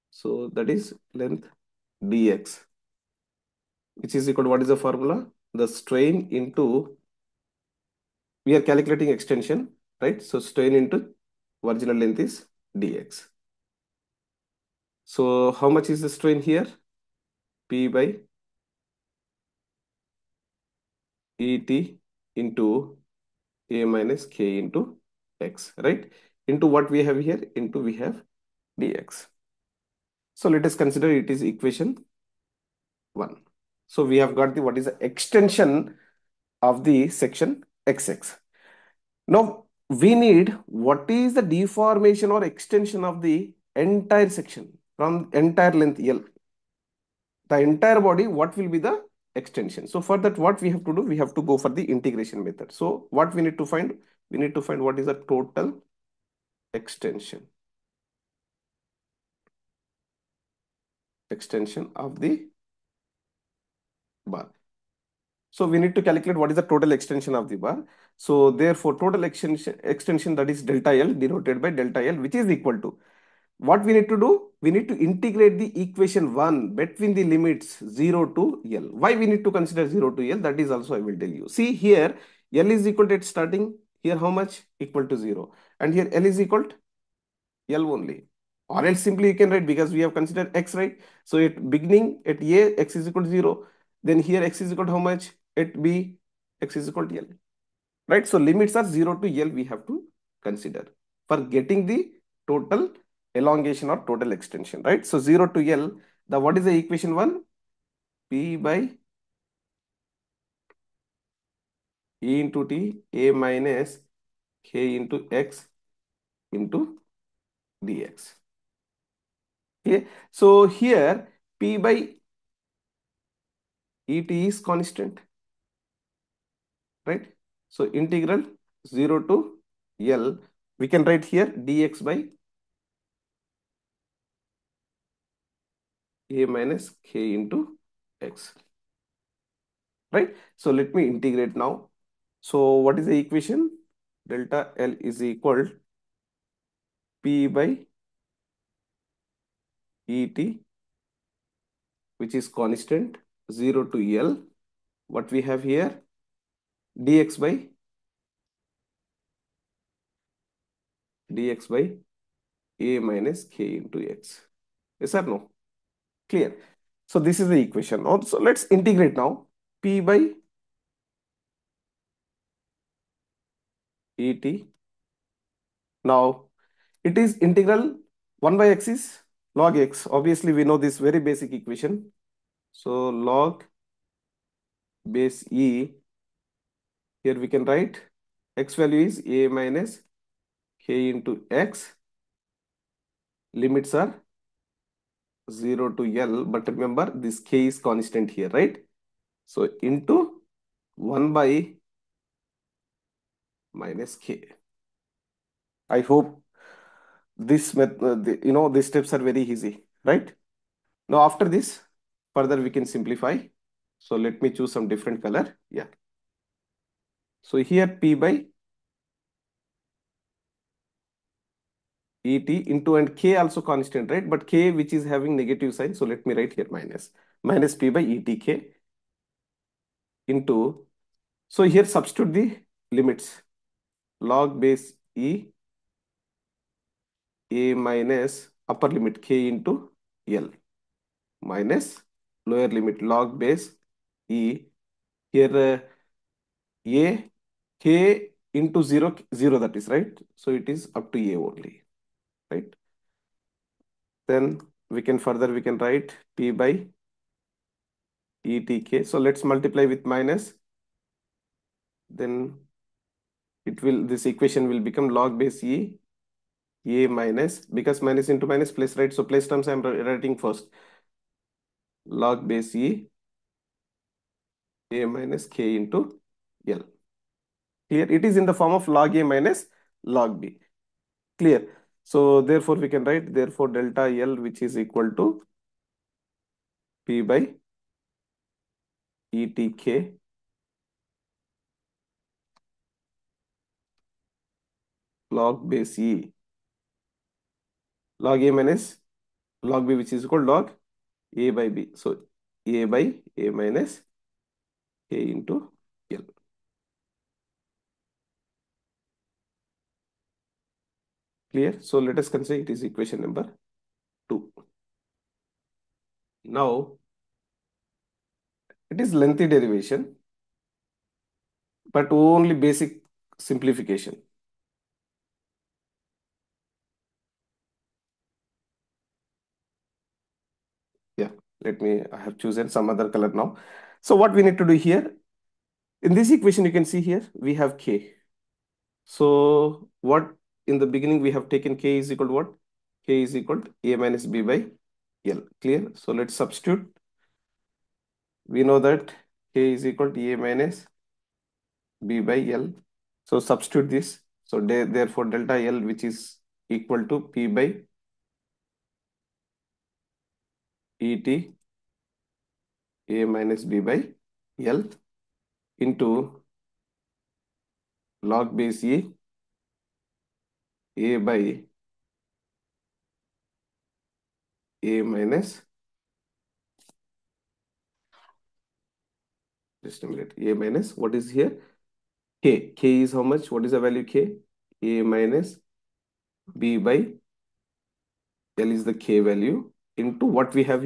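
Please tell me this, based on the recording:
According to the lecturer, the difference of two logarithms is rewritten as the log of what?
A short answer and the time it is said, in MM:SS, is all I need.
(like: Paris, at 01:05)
log A by B, at 05:00.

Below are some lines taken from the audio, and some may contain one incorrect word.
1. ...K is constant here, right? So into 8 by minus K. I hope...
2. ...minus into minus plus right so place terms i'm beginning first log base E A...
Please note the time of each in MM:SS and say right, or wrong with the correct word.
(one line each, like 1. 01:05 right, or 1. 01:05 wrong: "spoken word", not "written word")
1. 03:17 wrong: "1", not "8"
2. 04:28 wrong: "writing", not "beginning".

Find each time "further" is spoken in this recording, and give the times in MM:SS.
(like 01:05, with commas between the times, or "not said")
03:32, 04:15.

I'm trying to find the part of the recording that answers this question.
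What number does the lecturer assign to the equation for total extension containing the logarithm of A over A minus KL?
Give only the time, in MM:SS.
05:12.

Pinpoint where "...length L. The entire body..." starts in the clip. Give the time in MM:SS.
00:45.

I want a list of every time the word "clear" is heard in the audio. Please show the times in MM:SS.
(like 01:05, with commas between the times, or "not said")
02:46, 04:41, 05:11, 05:45.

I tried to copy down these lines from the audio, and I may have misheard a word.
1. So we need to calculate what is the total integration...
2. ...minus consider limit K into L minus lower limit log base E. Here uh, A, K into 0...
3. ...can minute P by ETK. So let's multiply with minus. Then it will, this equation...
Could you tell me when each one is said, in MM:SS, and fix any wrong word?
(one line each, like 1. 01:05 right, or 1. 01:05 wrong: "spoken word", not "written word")
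1. 01:05 wrong: "extension", not "integration"
2. 03:57 wrong: "upper", not "consider"
3. 04:15 wrong: "write", not "minute".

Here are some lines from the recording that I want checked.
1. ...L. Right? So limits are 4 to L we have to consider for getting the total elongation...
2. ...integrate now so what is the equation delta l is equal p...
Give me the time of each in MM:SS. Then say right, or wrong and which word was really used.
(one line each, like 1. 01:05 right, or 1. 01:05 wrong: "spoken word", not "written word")
1. 01:37 wrong: "0", not "4"
2. 02:21 right.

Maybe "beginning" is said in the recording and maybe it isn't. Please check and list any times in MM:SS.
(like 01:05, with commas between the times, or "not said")
01:31, 05:40.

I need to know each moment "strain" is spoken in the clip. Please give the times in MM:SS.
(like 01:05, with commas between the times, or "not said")
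00:05, 00:10, 00:16.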